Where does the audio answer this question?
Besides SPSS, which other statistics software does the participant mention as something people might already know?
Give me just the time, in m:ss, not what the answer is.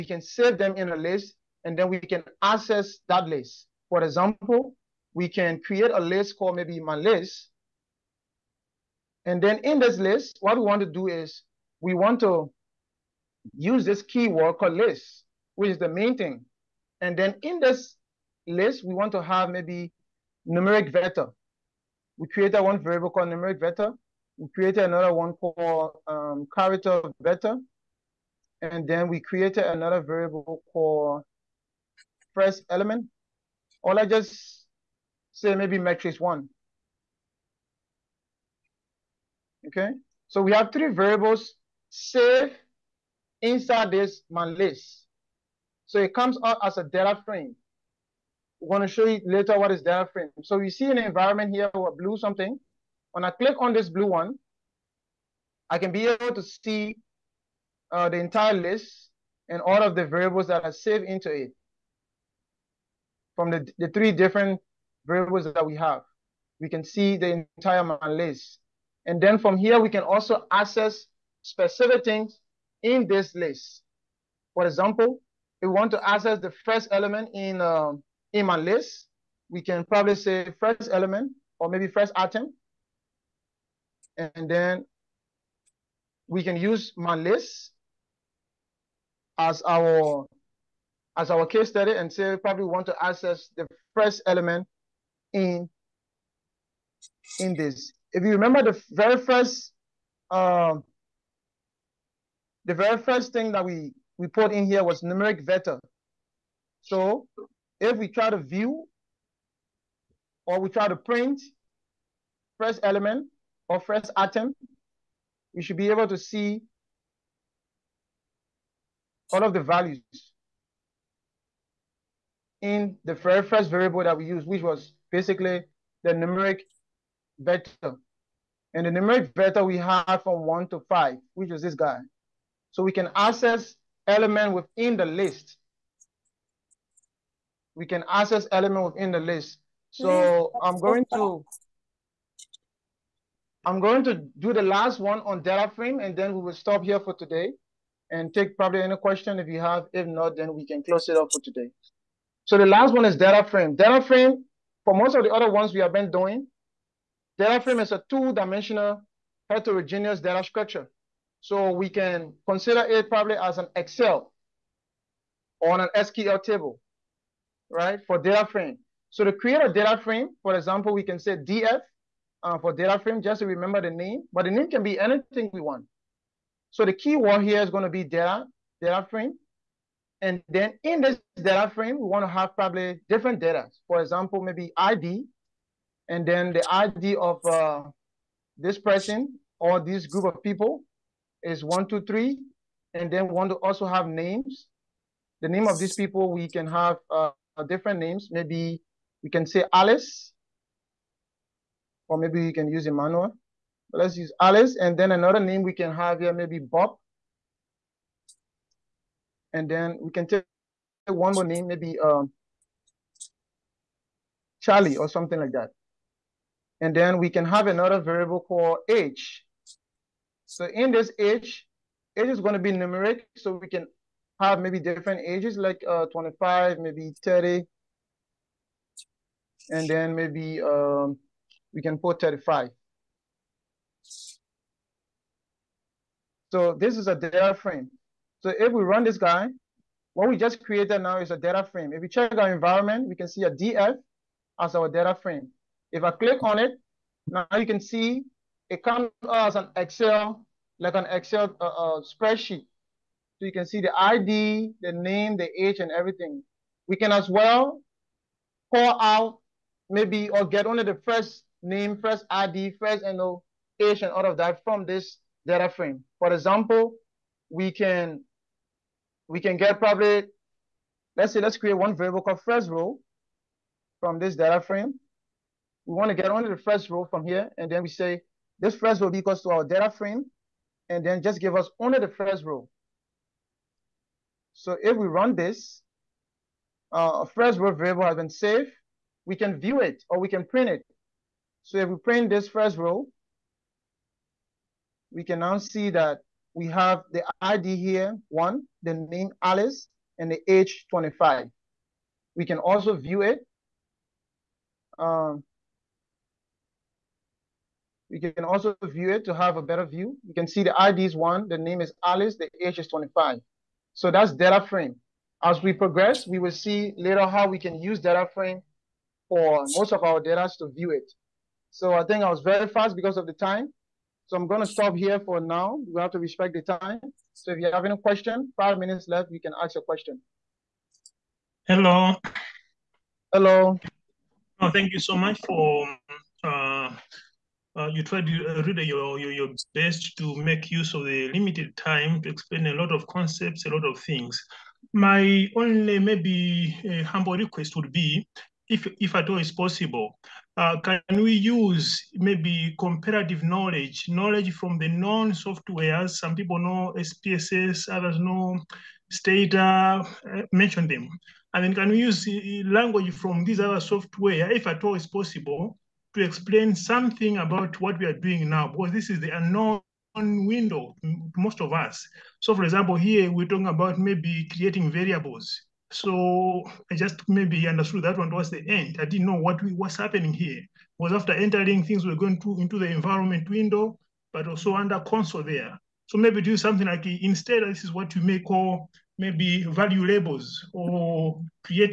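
5:59.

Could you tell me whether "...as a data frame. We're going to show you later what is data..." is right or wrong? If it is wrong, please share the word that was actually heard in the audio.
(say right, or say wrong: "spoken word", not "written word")
right.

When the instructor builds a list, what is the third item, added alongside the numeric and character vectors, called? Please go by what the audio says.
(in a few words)
matrix one.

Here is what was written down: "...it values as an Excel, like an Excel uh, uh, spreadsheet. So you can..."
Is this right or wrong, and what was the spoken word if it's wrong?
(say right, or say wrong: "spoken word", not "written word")
wrong: "comes", not "values".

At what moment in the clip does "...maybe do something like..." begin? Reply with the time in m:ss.
6:26.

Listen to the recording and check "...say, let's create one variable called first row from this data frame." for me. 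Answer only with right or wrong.
right.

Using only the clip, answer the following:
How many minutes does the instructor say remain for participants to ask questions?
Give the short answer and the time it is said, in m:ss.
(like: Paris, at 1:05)
5, at 5:28.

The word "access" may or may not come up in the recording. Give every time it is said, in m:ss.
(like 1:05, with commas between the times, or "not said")
0:02, 1:10, 1:16, 1:33, 2:13, 2:18.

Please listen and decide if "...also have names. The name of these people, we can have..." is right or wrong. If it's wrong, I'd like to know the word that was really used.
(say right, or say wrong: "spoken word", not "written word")
right.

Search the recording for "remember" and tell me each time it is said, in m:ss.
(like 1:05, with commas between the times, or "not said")
1:38, 2:53.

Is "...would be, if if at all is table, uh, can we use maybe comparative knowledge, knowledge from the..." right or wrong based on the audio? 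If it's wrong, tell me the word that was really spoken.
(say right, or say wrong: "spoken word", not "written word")
wrong: "possible", not "table".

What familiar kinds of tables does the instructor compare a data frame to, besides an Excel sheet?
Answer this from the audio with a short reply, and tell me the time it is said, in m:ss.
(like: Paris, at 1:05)
SQL table, at 2:45.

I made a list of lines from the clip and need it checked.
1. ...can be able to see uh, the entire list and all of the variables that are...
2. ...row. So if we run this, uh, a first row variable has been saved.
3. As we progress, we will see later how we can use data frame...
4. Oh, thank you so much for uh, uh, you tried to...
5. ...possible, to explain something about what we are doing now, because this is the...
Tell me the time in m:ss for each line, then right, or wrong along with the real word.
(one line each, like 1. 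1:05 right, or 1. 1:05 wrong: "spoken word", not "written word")
1. 0:55 right
2. 4:42 right
3. 5:15 right
4. 5:34 right
5. 6:05 right.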